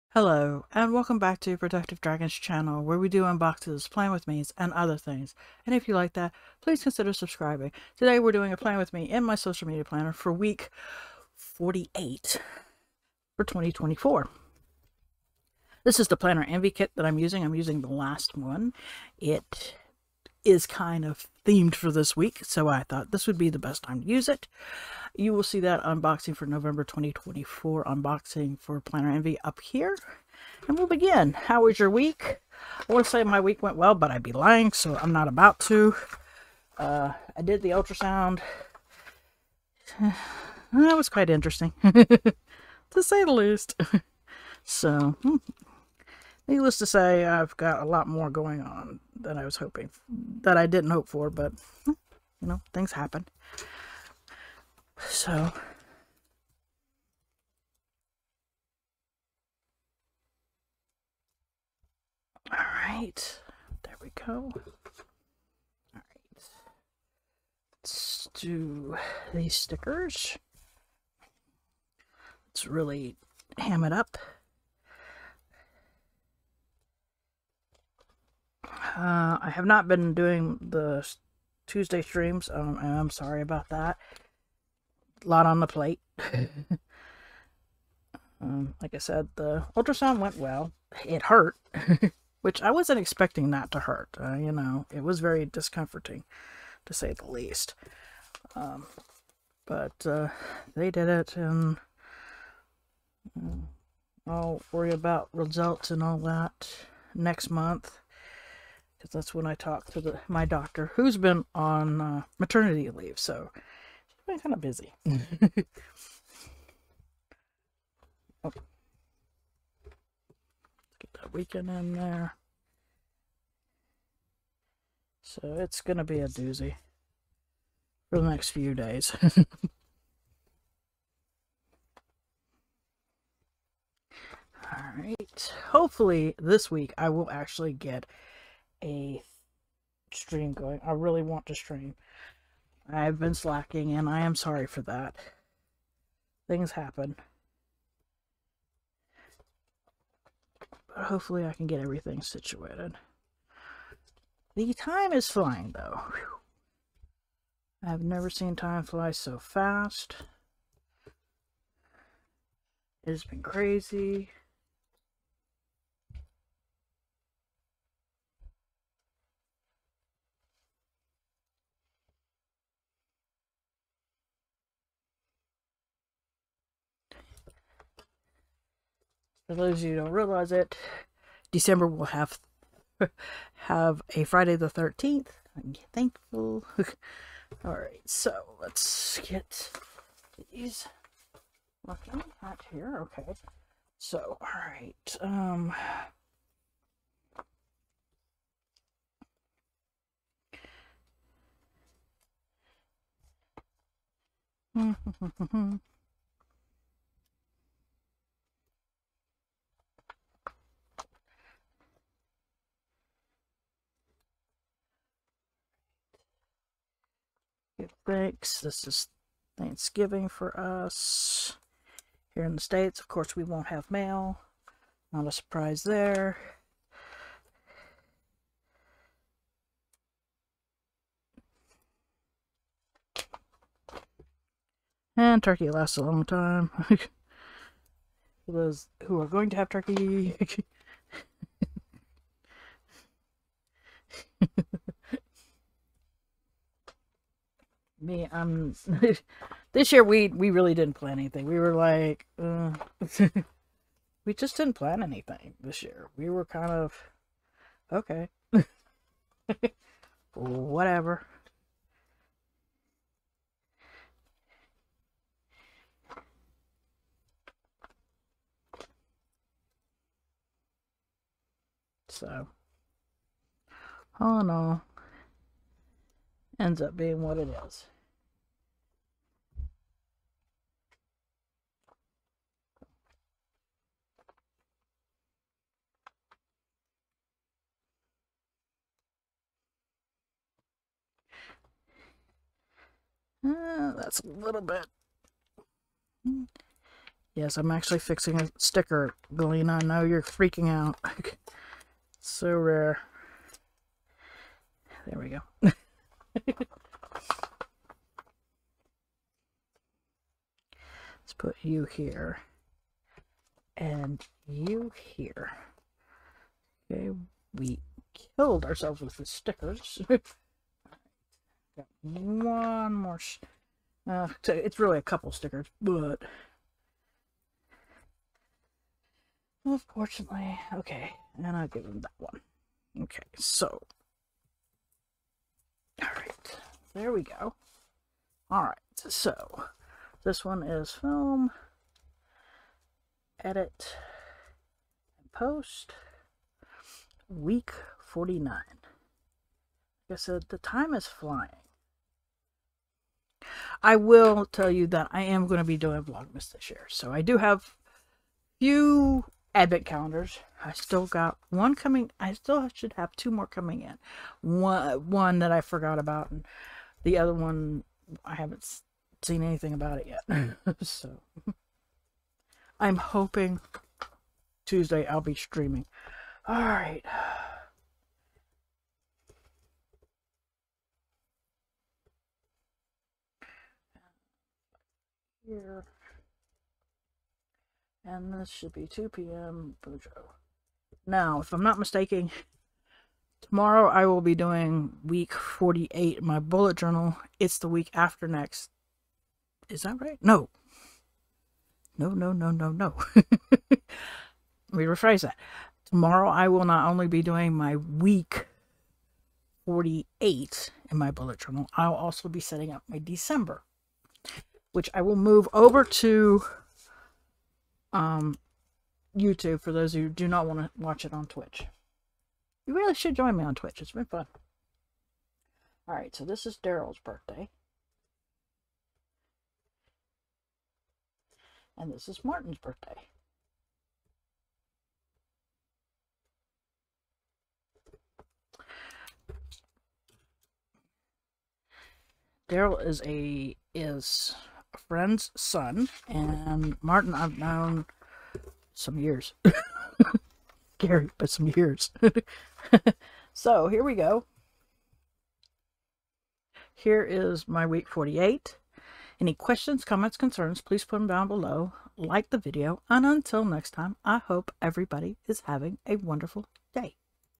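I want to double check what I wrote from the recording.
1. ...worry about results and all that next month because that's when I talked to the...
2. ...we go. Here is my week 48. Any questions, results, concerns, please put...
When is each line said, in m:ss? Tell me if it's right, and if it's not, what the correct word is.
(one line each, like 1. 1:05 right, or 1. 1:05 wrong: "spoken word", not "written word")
1. 1:44 right
2. 7:33 wrong: "comments", not "results".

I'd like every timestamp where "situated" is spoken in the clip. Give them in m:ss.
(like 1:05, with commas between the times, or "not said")
2:32.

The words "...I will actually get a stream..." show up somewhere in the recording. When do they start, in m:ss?
2:16.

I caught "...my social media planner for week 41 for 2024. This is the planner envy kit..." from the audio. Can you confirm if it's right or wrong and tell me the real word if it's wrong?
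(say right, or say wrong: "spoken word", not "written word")
wrong: "48", not "41".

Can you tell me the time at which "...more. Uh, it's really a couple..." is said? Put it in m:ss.
5:22.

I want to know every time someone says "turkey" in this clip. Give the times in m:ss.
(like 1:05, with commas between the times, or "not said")
3:55, 3:59.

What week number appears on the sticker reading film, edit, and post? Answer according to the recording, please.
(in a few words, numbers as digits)
49.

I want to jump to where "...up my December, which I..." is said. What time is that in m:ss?
6:52.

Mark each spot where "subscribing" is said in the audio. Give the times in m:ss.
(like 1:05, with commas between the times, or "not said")
0:07.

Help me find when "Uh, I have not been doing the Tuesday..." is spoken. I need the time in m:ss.
1:18.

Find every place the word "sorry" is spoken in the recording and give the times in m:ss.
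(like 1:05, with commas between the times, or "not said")
1:23, 2:24.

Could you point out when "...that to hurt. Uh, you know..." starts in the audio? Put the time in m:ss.
1:33.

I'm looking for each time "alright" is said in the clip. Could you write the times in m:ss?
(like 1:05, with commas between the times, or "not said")
2:14, 3:07, 3:14, 7:05.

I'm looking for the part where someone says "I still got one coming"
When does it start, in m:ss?
6:00.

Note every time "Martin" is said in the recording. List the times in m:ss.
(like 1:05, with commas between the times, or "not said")
7:12, 7:26.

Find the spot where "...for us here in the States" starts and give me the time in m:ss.
3:40.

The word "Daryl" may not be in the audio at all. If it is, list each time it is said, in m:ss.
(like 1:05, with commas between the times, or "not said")
7:06, 7:22.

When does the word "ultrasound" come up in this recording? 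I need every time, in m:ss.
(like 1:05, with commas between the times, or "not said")
0:37, 1:29.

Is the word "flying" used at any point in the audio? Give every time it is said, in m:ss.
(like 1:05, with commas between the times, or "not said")
2:35, 5:51.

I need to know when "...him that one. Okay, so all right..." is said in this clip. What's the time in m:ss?
5:31.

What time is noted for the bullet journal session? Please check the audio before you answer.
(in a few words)
2 p.m.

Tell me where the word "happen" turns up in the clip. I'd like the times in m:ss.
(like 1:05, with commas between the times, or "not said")
0:52, 2:26.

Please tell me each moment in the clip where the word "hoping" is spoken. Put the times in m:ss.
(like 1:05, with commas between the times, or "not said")
0:49, 6:12.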